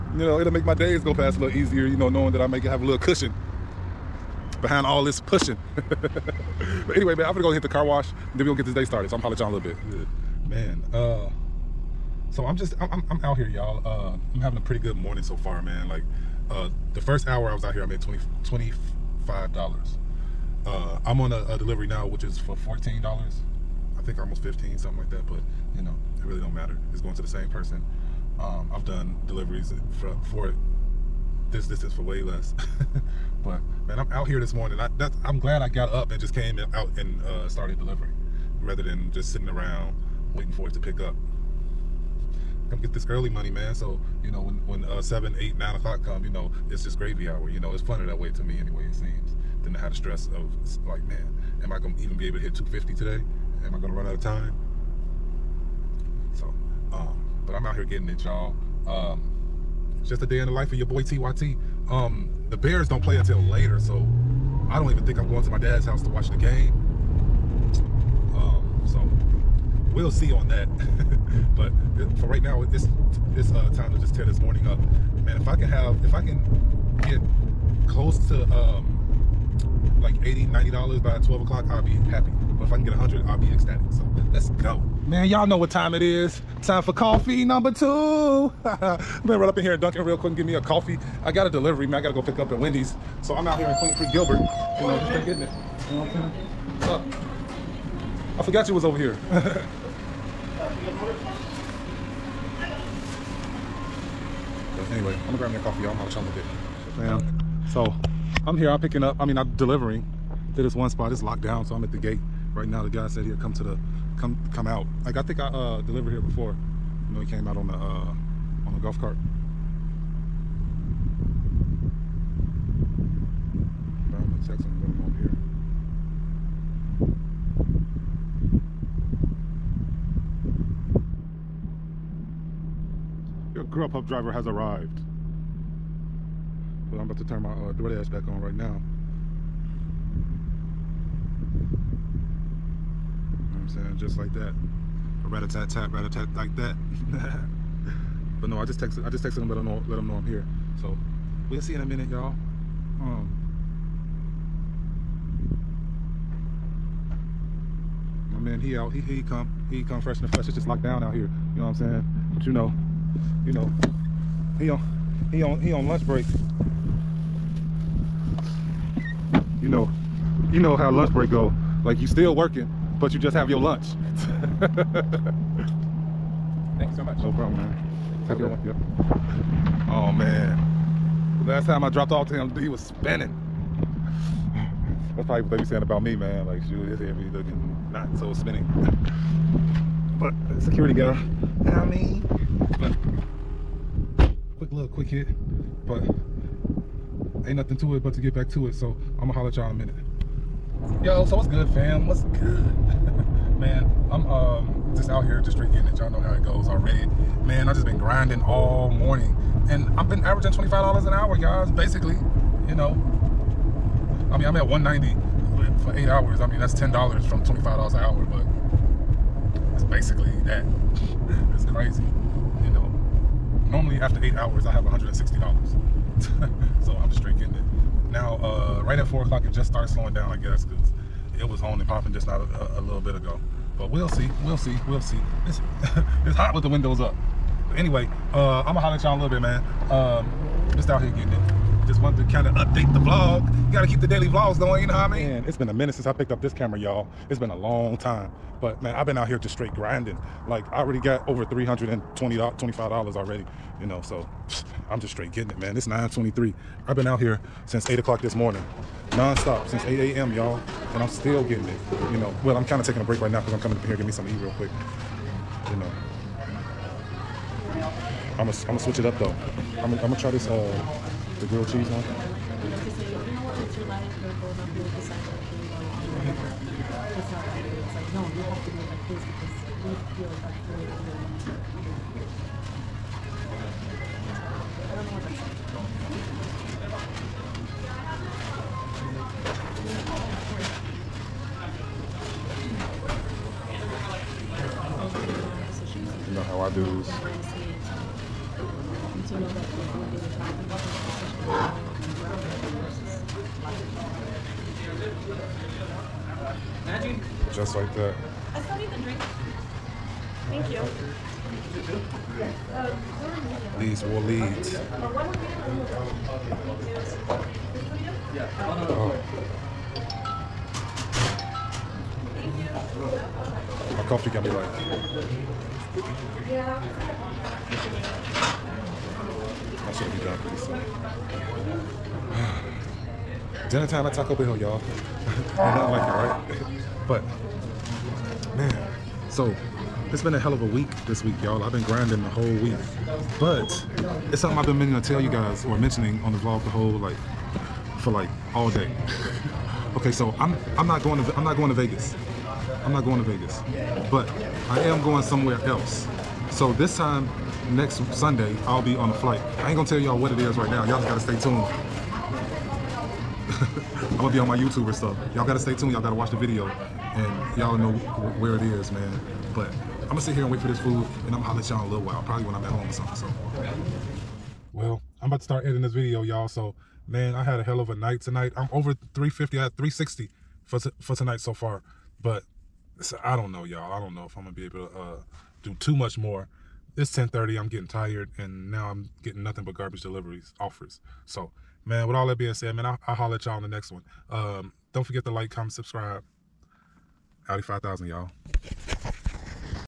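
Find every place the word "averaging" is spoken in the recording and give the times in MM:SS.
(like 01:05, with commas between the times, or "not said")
03:30.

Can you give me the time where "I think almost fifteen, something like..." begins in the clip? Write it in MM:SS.
00:23.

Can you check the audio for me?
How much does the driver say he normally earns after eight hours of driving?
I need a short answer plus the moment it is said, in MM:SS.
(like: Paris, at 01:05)
$160, at 03:44.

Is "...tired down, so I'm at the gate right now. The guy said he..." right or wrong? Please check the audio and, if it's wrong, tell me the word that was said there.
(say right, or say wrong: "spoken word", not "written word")
wrong: "locked", not "tired".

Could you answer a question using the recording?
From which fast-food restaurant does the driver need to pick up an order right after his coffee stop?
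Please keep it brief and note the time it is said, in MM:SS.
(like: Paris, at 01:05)
Wendy's, at 01:32.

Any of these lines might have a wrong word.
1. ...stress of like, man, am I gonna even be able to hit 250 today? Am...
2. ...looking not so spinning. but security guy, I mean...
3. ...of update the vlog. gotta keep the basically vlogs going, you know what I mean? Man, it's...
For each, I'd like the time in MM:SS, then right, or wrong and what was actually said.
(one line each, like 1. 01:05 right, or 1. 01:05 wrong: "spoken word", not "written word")
1. 00:49 right
2. 03:07 right
3. 04:02 wrong: "daily", not "basically".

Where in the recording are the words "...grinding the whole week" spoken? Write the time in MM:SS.
05:41.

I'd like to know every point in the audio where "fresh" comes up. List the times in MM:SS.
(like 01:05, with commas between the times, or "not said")
02:39.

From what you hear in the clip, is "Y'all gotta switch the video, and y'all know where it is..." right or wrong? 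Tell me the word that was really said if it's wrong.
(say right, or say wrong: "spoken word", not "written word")
wrong: "watch", not "switch".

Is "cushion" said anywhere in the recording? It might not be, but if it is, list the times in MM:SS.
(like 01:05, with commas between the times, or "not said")
00:02.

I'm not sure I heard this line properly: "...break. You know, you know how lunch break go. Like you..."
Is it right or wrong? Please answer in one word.
right.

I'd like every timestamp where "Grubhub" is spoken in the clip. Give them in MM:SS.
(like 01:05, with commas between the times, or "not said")
02:13.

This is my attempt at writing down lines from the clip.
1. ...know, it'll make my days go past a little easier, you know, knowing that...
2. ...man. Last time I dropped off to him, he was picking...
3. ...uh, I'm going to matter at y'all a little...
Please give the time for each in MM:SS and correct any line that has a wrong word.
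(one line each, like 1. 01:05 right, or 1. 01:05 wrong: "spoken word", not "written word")
1. 00:00 right
2. 03:00 wrong: "spinning", not "picking"
3. 03:58 wrong: "holler", not "matter".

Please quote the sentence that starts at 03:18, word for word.
So I'm gonna holler at y'all in a minute.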